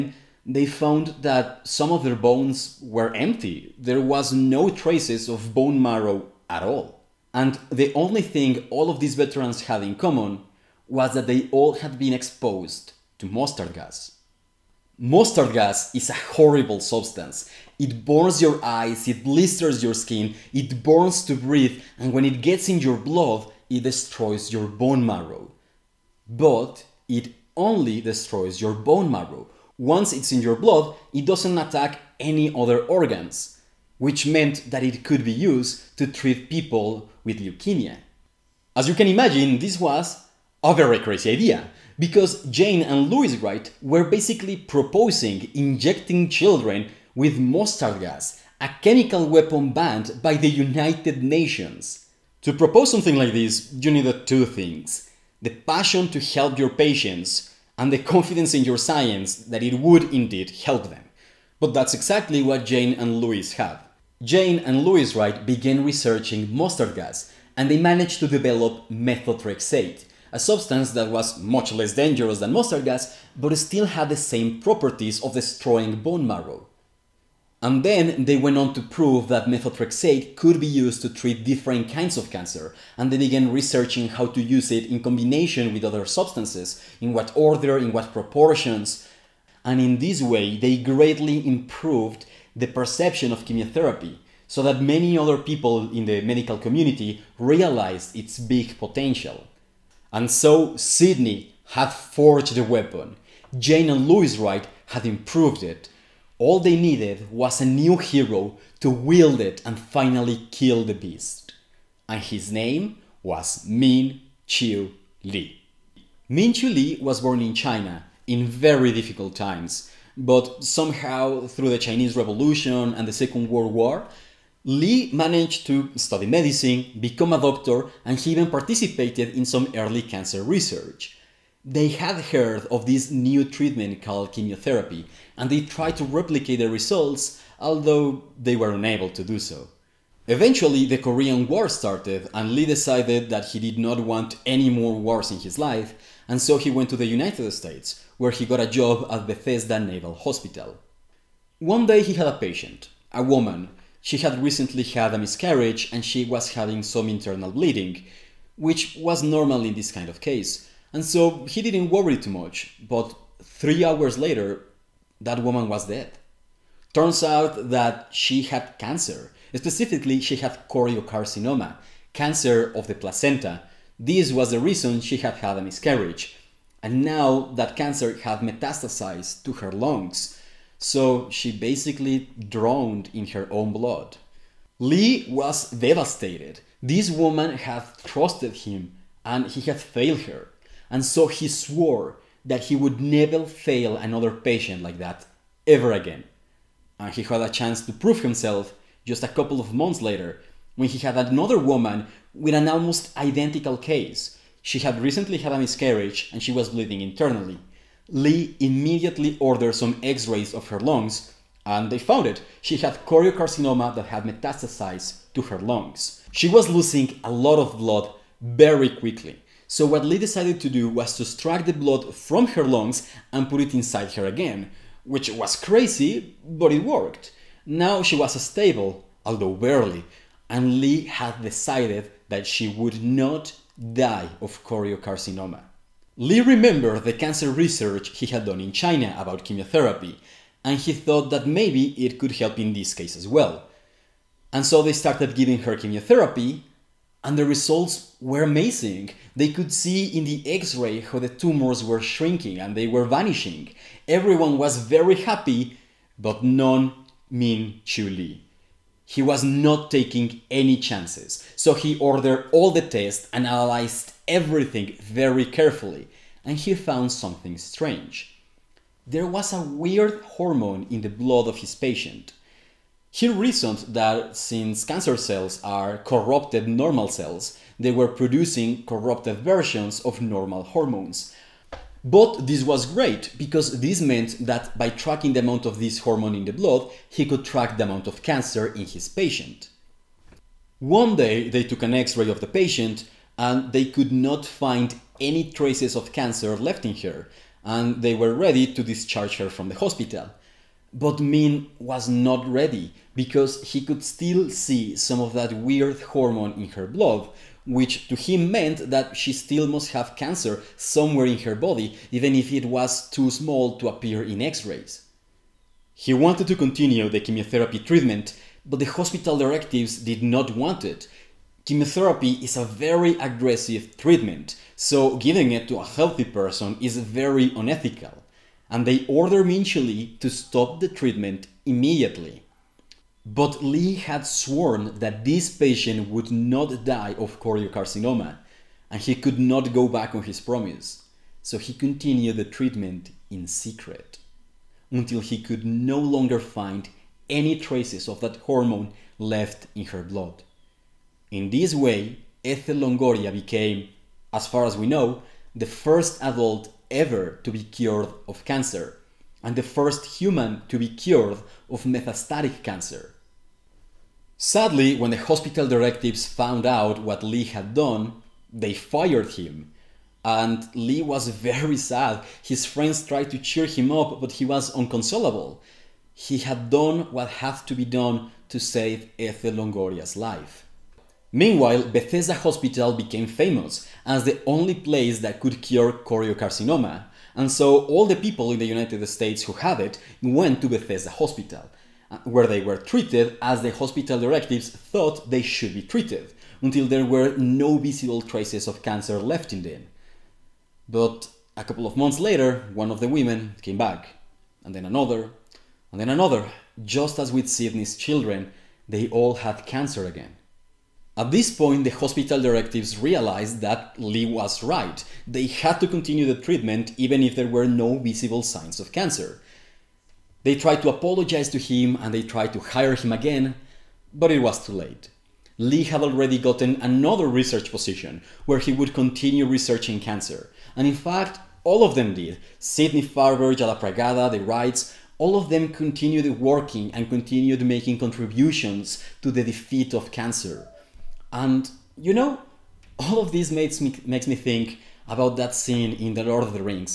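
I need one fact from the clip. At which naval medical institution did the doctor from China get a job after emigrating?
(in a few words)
Bethesda Naval Hospital.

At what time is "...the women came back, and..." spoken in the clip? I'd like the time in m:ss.
6:42.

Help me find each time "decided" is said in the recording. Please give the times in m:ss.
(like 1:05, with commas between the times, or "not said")
2:22, 3:40, 3:51.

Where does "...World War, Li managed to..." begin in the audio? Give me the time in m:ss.
2:03.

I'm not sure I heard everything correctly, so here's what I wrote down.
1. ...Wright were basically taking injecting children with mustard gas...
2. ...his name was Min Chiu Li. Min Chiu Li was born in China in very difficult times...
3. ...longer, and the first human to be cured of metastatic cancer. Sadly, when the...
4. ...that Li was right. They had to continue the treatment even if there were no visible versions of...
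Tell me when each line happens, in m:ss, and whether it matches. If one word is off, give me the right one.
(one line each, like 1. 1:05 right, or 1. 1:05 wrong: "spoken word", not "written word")
1. 0:43 wrong: "proposing", not "taking"
2. 1:52 right
3. 5:58 wrong: "cancer", not "longer"
4. 6:53 wrong: "signs", not "versions".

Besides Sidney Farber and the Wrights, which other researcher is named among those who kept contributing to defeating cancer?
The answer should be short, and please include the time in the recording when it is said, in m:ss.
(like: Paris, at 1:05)
Yellapragada, at 7:13.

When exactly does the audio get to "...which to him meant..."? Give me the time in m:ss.
5:07.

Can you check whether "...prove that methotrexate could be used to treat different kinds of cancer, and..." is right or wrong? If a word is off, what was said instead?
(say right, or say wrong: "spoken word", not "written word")
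right.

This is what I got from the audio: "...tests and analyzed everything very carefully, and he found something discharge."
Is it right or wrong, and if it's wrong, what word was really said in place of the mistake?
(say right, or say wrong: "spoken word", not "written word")
wrong: "strange", not "discharge".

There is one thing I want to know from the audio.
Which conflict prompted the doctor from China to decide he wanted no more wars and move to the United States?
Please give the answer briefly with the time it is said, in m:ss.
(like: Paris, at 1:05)
Korean War, at 2:20.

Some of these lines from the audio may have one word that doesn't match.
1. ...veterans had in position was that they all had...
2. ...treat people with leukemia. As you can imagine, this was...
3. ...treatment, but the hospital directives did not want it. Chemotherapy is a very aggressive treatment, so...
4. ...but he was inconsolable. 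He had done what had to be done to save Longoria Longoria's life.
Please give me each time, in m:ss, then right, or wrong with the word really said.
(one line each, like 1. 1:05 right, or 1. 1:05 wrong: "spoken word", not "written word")
1. 0:09 wrong: "common", not "position"
2. 0:36 right
3. 5:17 right
4. 6:14 wrong: "Ethel", not "Longoria".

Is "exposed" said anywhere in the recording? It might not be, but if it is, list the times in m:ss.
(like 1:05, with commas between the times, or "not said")
0:12.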